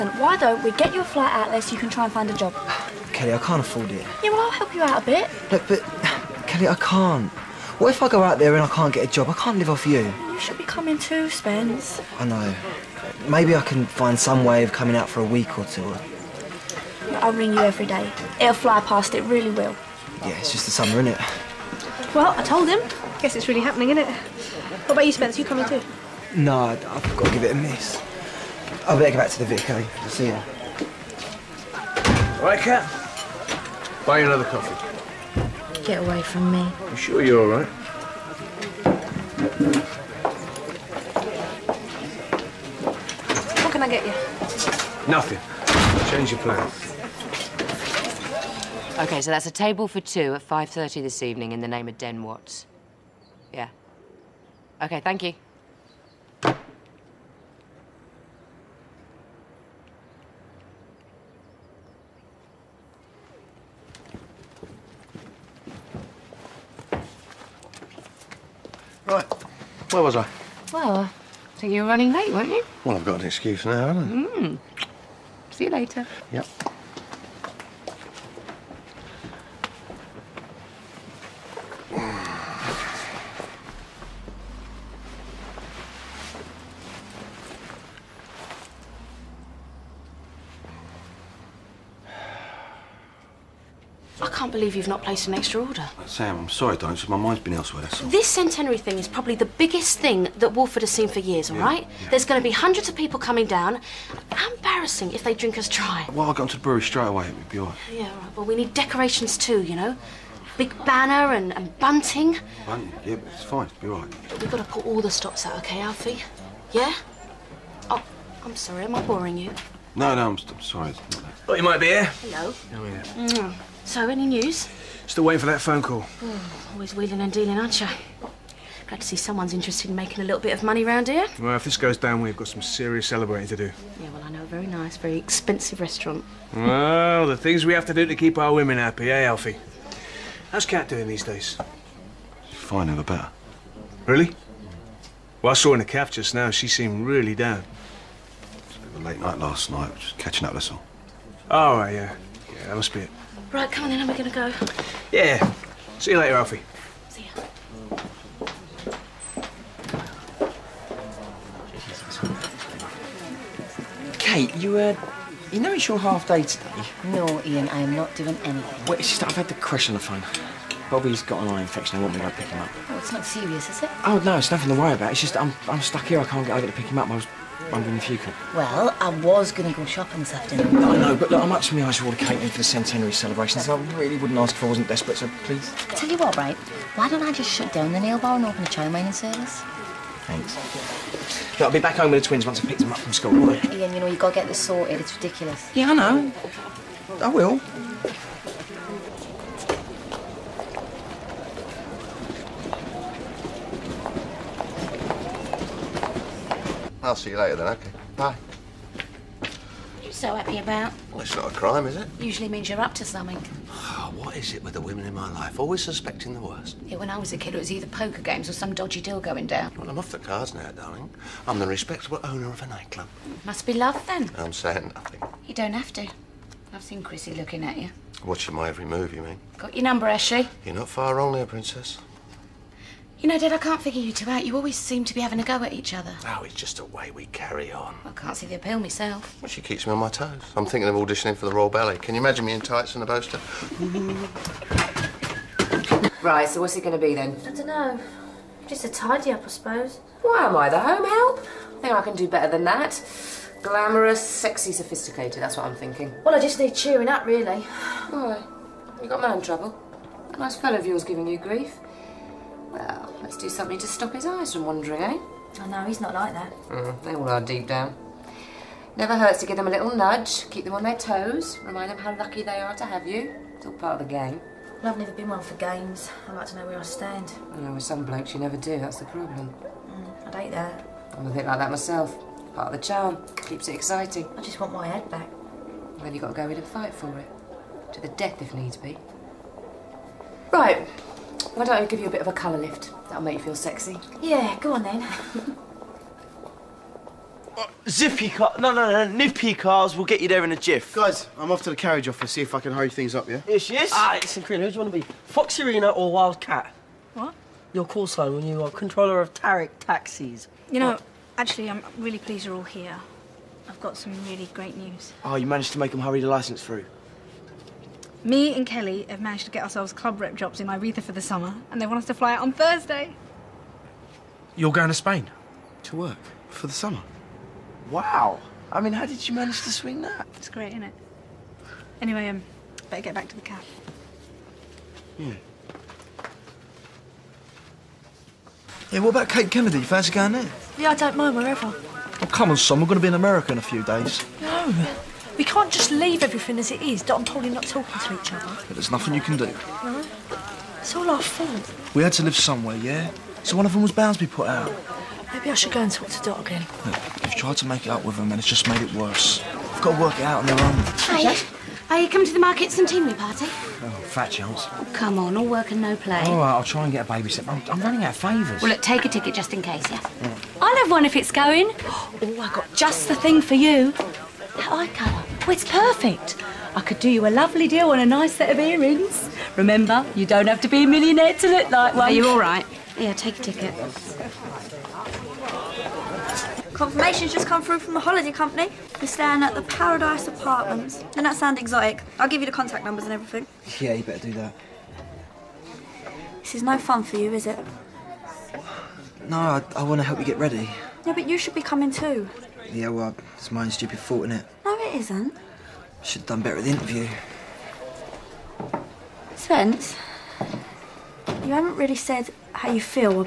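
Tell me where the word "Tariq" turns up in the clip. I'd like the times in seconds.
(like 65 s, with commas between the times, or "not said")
309 s.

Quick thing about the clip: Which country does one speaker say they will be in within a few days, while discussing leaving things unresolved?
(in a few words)
America.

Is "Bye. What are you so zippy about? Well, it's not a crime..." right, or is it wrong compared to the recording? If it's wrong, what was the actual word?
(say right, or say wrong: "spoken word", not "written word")
wrong: "happy", not "zippy".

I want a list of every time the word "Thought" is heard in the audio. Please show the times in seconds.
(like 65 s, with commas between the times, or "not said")
121 s.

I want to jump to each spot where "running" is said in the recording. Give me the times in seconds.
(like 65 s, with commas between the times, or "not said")
71 s, 367 s.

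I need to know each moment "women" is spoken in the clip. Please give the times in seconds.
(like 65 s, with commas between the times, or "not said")
138 s, 214 s.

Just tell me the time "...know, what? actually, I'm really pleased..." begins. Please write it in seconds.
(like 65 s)
310 s.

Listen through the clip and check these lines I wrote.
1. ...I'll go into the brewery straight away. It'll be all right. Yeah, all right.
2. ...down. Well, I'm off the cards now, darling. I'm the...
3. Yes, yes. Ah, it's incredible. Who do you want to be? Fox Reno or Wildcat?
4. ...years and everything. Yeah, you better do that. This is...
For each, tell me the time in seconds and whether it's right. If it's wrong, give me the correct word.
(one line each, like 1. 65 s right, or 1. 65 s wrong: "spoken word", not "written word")
1. 106 s right
2. 219 s right
3. 303 s right
4. 392 s wrong: "numbers", not "years".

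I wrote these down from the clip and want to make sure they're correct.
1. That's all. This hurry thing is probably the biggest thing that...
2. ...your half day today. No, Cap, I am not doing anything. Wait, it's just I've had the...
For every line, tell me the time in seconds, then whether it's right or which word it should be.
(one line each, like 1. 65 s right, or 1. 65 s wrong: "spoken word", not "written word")
1. 97 s wrong: "centenary", not "hurry"
2. 165 s wrong: "Ian", not "Cap".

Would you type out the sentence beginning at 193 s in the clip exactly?
Ian, you know, you've got to get this sorted.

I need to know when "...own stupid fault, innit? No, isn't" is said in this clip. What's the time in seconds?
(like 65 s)
403 s.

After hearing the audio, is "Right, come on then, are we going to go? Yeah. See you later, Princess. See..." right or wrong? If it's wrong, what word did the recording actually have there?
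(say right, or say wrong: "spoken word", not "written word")
wrong: "Alfie", not "Princess".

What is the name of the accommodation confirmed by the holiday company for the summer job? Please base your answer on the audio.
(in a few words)
Paradise Apartments.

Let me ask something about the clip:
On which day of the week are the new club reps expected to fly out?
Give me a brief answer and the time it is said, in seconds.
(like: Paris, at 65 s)
Thursday, at 322 s.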